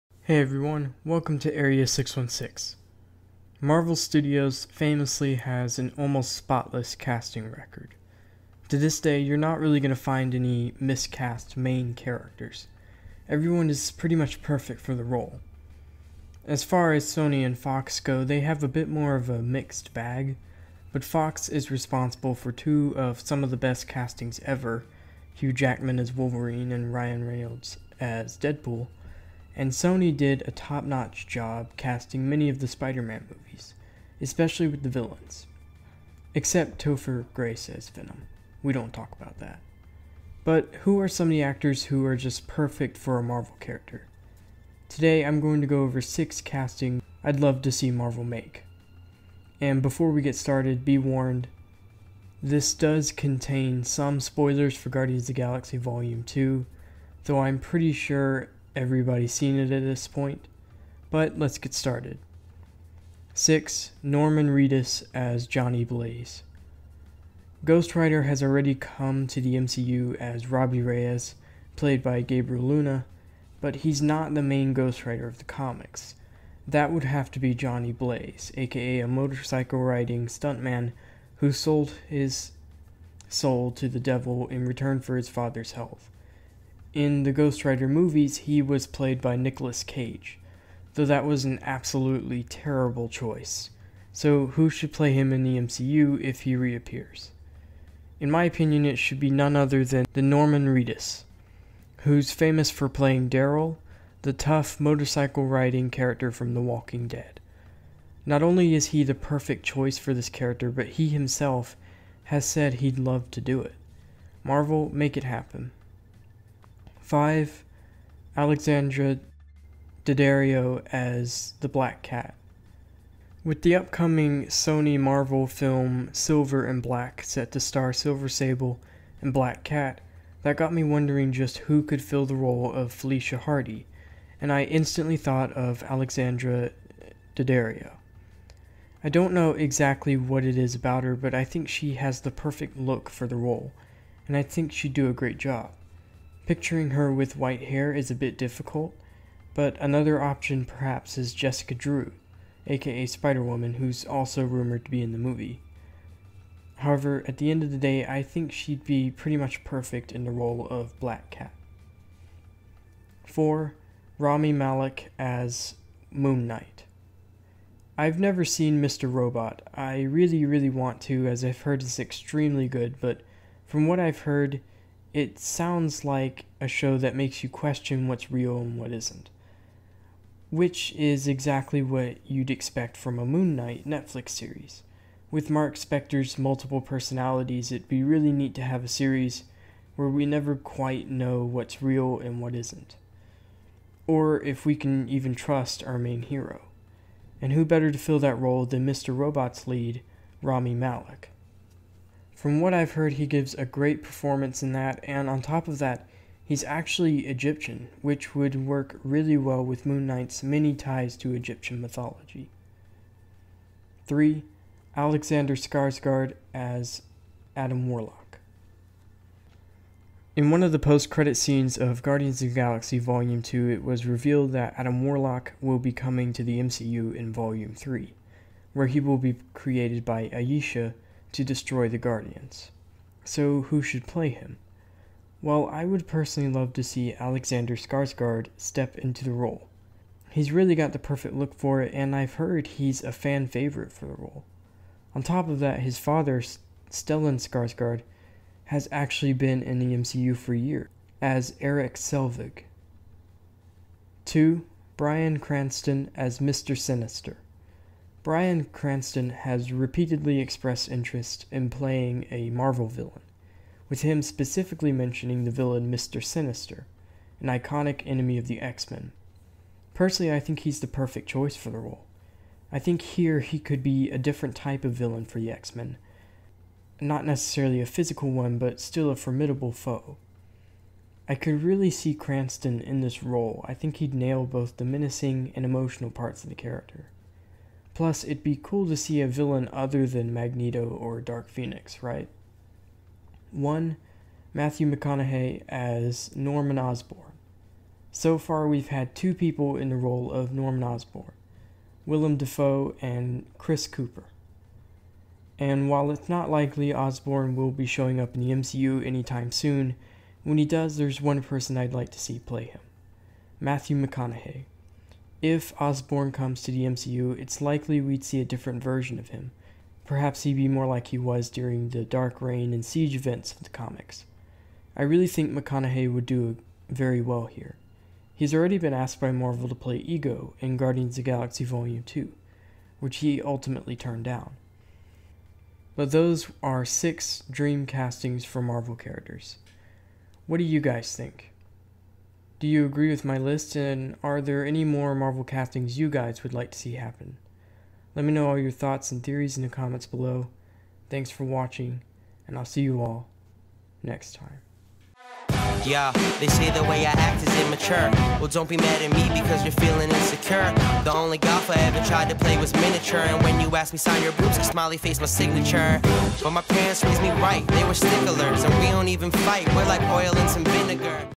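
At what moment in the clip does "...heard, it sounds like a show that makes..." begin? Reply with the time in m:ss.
2:54.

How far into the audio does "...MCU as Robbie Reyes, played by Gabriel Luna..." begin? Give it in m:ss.
1:09.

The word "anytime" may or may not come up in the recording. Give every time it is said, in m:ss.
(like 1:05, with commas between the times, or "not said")
5:09.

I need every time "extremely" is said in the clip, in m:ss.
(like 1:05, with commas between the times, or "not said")
2:51.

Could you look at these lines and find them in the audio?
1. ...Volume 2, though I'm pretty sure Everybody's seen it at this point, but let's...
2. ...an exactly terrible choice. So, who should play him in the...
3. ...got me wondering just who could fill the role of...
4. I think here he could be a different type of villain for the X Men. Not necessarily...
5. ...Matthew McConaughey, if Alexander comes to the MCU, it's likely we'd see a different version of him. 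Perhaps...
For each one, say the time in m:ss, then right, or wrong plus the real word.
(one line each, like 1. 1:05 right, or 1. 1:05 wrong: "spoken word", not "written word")
1. 0:55 right
2. 1:31 wrong: "absolutely", not "exactly"
3. 2:10 right
4. 4:32 right
5. 5:13 wrong: "Osborn", not "Alexander".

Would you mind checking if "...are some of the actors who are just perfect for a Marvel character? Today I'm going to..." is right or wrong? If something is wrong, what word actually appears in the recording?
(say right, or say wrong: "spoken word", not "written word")
right.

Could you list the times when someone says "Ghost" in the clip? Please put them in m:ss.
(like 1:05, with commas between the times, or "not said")
1:07, 1:14, 1:27.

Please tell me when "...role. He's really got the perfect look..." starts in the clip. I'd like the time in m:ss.
3:59.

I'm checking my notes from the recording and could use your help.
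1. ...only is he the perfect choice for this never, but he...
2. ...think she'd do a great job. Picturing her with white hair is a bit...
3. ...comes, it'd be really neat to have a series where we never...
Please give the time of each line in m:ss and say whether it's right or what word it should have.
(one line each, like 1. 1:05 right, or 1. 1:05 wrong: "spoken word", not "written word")
1. 1:48 wrong: "character", not "never"
2. 2:24 right
3. 3:06 wrong: "personalities", not "comes".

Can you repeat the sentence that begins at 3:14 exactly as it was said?
Or if we can even trust our main hero.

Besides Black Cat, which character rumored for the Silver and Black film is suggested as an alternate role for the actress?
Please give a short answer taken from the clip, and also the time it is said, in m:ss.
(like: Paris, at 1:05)
Jessica Drew, at 2:31.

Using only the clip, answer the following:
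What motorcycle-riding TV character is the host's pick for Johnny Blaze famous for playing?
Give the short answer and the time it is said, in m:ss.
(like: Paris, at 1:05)
Daryl, at 1:43.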